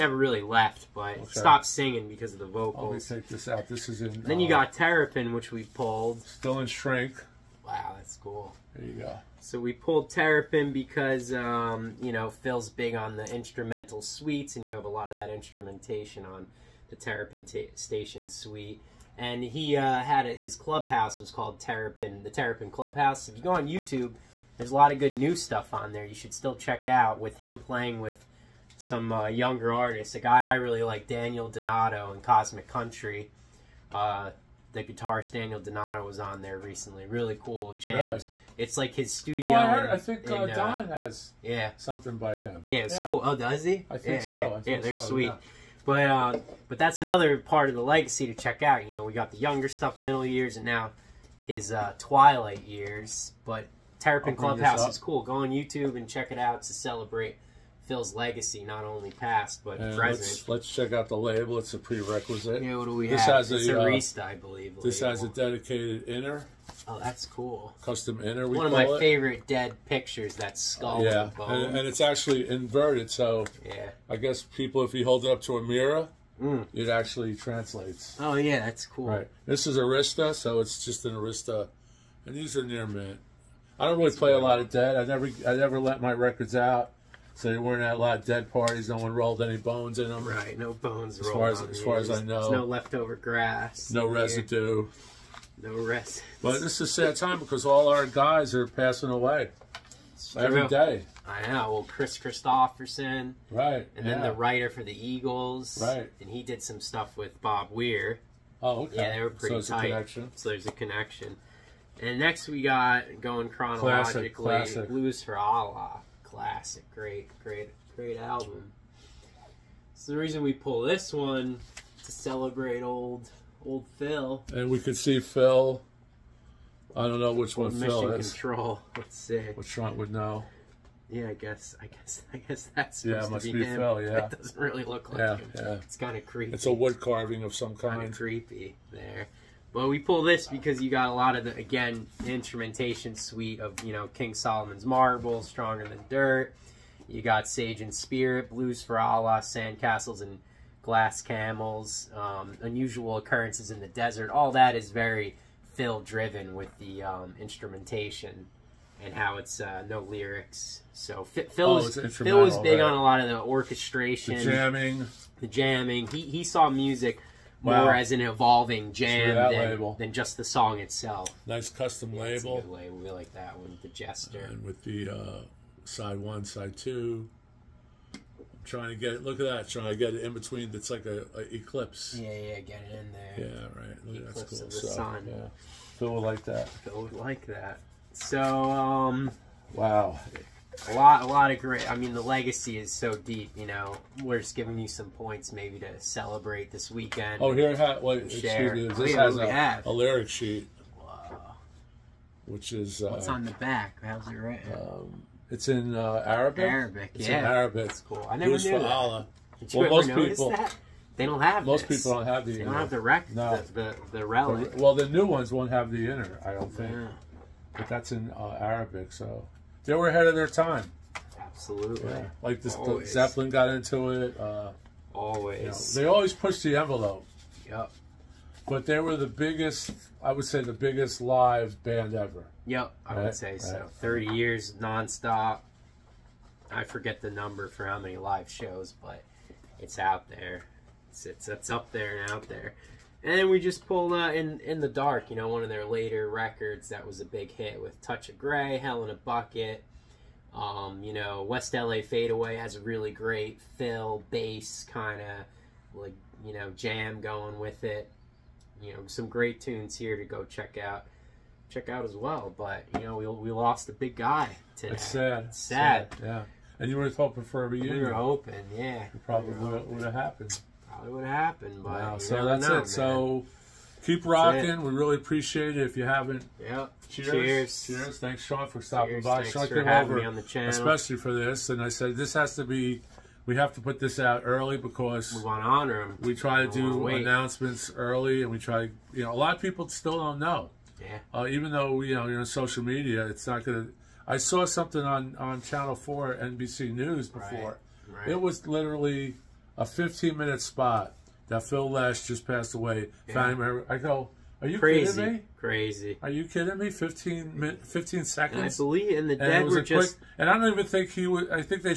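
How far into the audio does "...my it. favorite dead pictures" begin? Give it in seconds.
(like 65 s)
68 s.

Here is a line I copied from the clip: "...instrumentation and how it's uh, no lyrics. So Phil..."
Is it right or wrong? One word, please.
right.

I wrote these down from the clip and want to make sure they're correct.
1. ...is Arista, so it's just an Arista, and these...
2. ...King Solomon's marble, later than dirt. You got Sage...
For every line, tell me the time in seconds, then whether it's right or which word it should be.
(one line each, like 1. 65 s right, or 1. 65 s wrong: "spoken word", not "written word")
1. 79 s right
2. 144 s wrong: "stronger", not "later".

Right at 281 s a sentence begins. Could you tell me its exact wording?
And I said this has to be we have to put this out early because we want to honor him.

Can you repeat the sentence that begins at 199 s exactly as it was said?
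a lyric sheet, which is uh, what's on the back.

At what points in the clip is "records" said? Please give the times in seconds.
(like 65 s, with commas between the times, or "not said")
86 s, 246 s.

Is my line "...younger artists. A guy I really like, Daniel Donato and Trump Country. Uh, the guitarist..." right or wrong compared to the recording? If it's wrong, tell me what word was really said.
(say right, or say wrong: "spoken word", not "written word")
wrong: "Cosmic", not "Trump".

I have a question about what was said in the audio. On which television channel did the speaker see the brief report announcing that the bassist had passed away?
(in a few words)
Channel Four NBC News.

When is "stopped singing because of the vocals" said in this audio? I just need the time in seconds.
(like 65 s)
1 s.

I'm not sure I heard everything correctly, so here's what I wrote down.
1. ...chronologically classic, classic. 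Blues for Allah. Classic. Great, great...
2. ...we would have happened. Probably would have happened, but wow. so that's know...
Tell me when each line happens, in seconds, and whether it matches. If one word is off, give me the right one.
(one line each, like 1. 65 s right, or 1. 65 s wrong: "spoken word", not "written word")
1. 113 s right
2. 269 s right.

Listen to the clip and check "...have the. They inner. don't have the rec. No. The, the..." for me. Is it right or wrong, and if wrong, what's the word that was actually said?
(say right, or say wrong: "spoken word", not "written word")
right.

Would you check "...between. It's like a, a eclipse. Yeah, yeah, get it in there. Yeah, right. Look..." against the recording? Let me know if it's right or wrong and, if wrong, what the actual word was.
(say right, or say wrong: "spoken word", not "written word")
right.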